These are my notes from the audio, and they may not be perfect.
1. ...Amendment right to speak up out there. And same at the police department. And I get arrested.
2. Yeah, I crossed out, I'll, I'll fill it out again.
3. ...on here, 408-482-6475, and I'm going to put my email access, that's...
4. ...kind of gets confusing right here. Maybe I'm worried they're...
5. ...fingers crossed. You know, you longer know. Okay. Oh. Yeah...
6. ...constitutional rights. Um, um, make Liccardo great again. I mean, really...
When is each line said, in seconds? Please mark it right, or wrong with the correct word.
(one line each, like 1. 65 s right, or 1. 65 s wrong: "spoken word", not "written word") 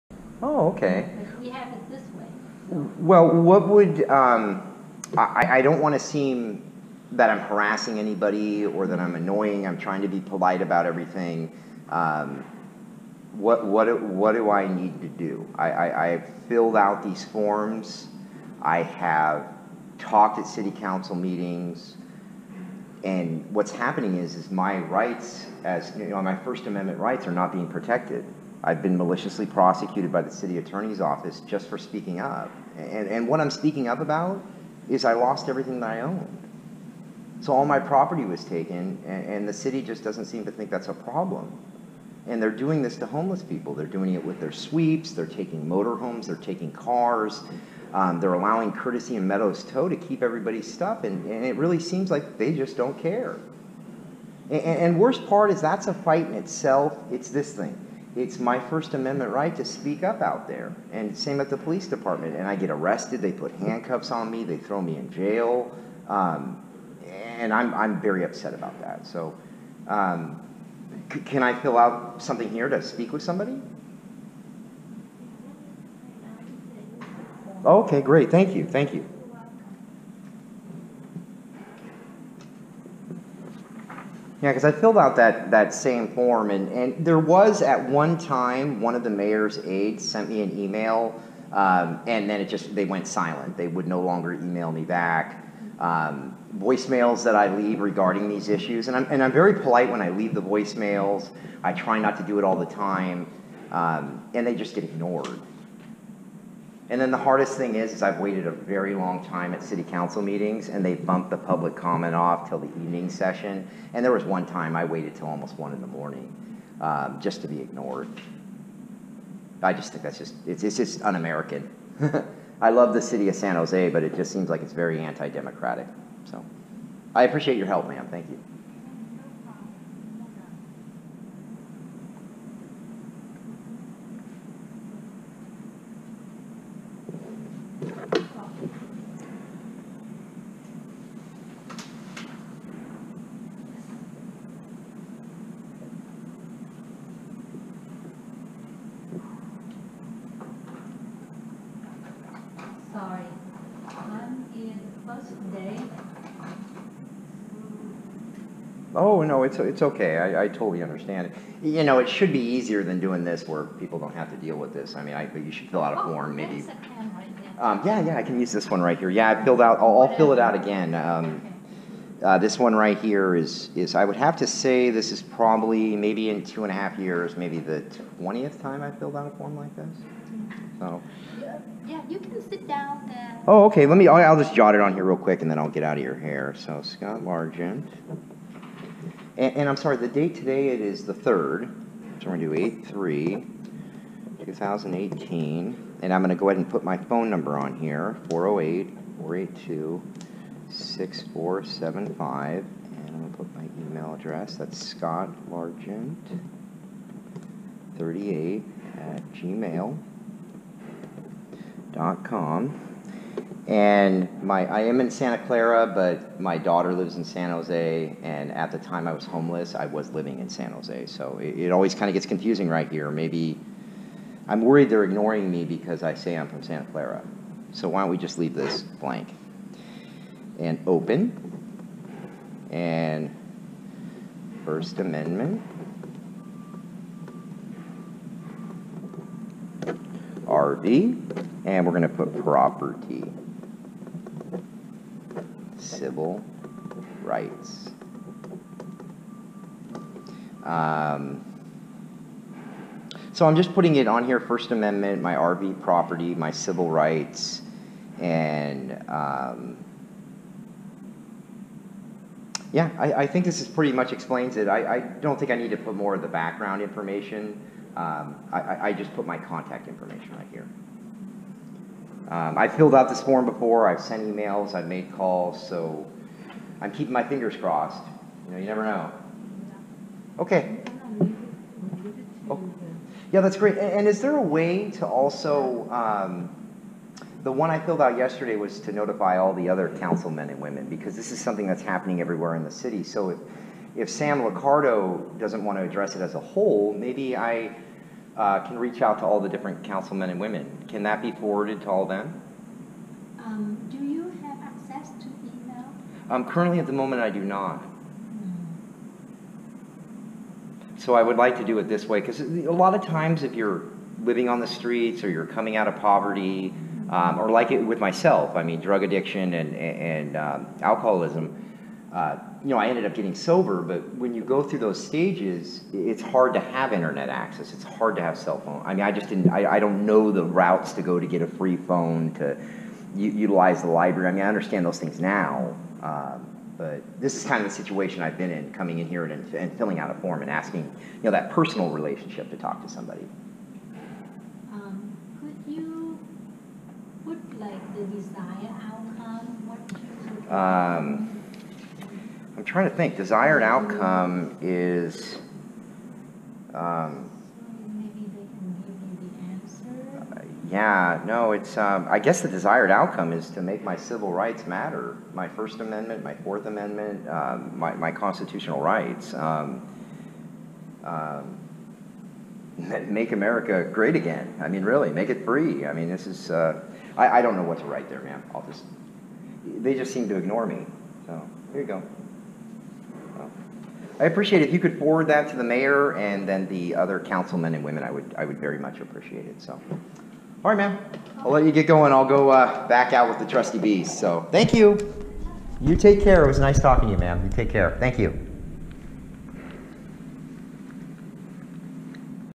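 1. 58 s right
2. 169 s wrong: "filled", not "crossed"
3. 197 s wrong: "address", not "access"
4. 221 s right
5. 277 s wrong: "never", not "longer"
6. 368 s wrong: "America", not "Liccardo".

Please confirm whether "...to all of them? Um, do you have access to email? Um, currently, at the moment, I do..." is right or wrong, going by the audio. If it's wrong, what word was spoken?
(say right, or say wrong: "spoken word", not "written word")
right.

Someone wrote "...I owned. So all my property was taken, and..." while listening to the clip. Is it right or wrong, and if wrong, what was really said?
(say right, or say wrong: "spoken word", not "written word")
right.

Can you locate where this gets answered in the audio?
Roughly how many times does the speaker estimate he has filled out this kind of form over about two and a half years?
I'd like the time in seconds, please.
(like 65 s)
177 s.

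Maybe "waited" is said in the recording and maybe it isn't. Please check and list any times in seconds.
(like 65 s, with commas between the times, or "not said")
108 s, 114 s.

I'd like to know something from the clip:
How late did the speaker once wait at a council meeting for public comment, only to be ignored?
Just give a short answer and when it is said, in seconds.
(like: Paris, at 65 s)
almost 1 in the morning, at 115 s.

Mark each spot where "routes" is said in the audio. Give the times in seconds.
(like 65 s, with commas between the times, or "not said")
330 s.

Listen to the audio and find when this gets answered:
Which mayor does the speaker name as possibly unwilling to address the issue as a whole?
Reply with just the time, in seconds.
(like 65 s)
294 s.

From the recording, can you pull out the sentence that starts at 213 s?
And my, I am in Santa Clara, but my daughter lives in San Jose.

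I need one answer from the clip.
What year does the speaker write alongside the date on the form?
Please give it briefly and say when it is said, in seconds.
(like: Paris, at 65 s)
2018, at 194 s.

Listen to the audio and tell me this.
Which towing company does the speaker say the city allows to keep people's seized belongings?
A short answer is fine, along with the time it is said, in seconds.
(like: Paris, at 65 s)
Courtesy and Meadows Tow, at 48 s.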